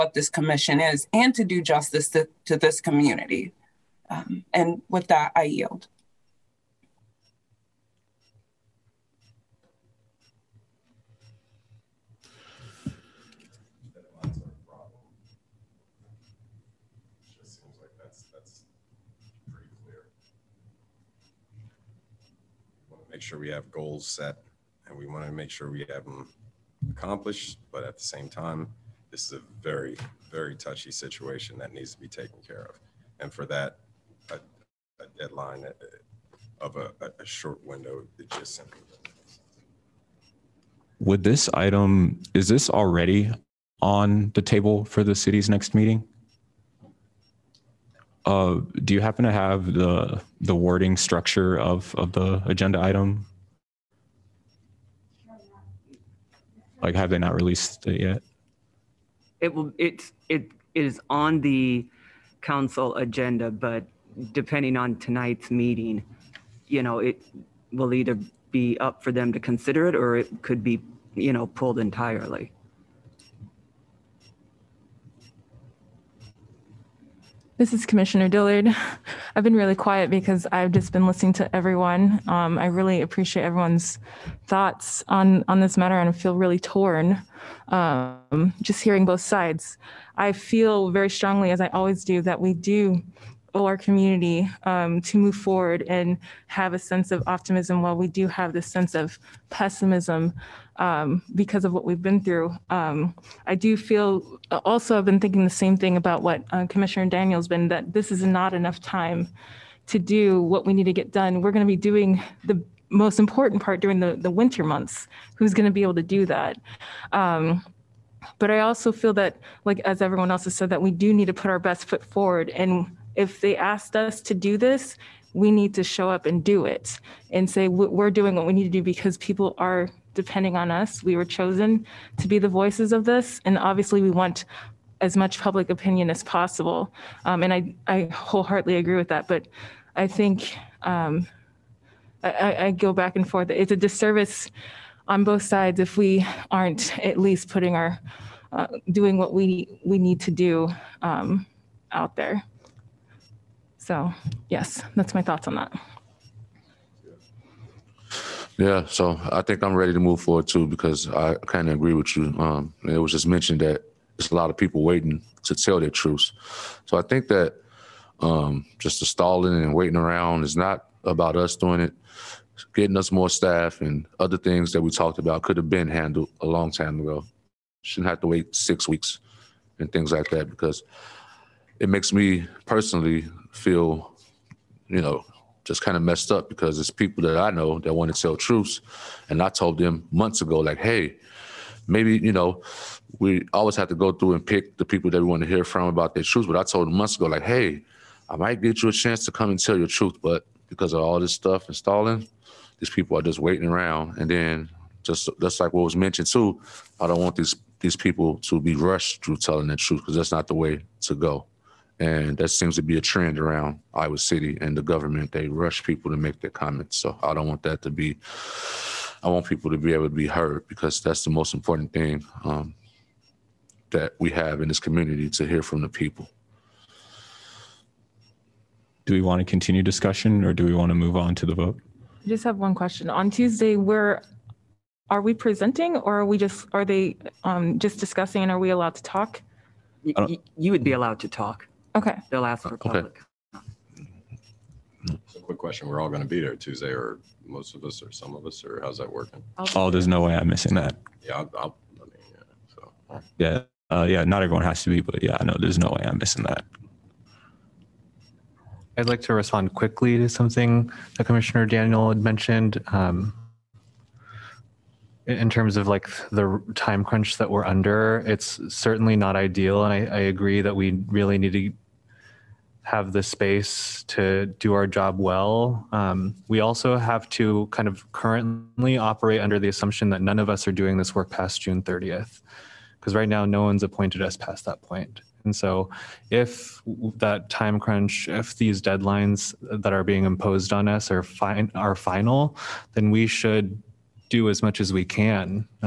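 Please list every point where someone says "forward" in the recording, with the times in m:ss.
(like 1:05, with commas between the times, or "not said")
1:35, 2:02, 2:40.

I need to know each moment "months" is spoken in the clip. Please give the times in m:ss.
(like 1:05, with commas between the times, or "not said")
1:54, 3:10, 3:16.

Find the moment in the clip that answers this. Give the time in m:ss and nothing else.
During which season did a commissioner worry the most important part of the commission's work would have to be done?
1:54.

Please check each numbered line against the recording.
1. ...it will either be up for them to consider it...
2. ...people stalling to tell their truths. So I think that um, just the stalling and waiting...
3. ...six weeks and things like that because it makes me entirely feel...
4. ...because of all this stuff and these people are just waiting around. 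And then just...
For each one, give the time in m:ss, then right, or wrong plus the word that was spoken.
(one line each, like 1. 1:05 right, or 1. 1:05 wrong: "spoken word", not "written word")
1. 1:07 right
2. 2:44 wrong: "waiting", not "stalling"
3. 2:58 wrong: "personally", not "entirely"
4. 3:20 right.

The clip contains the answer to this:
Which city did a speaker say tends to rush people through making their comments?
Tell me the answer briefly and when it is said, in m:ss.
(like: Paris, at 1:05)
Iowa City, at 3:33.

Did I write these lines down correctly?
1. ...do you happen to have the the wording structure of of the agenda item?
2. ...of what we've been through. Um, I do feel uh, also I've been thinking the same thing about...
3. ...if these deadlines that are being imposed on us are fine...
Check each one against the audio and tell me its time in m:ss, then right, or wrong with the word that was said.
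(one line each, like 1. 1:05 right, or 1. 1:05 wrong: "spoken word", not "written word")
1. 0:48 right
2. 1:41 right
3. 4:48 right.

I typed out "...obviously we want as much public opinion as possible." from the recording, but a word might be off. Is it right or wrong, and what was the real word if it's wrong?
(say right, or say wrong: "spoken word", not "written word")
right.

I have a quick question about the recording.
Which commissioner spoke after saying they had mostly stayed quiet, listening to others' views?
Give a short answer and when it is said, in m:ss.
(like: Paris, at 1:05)
Dillard, at 1:18.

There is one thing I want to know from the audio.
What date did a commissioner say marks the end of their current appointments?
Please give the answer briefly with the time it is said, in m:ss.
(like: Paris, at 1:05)
June 30th, at 4:41.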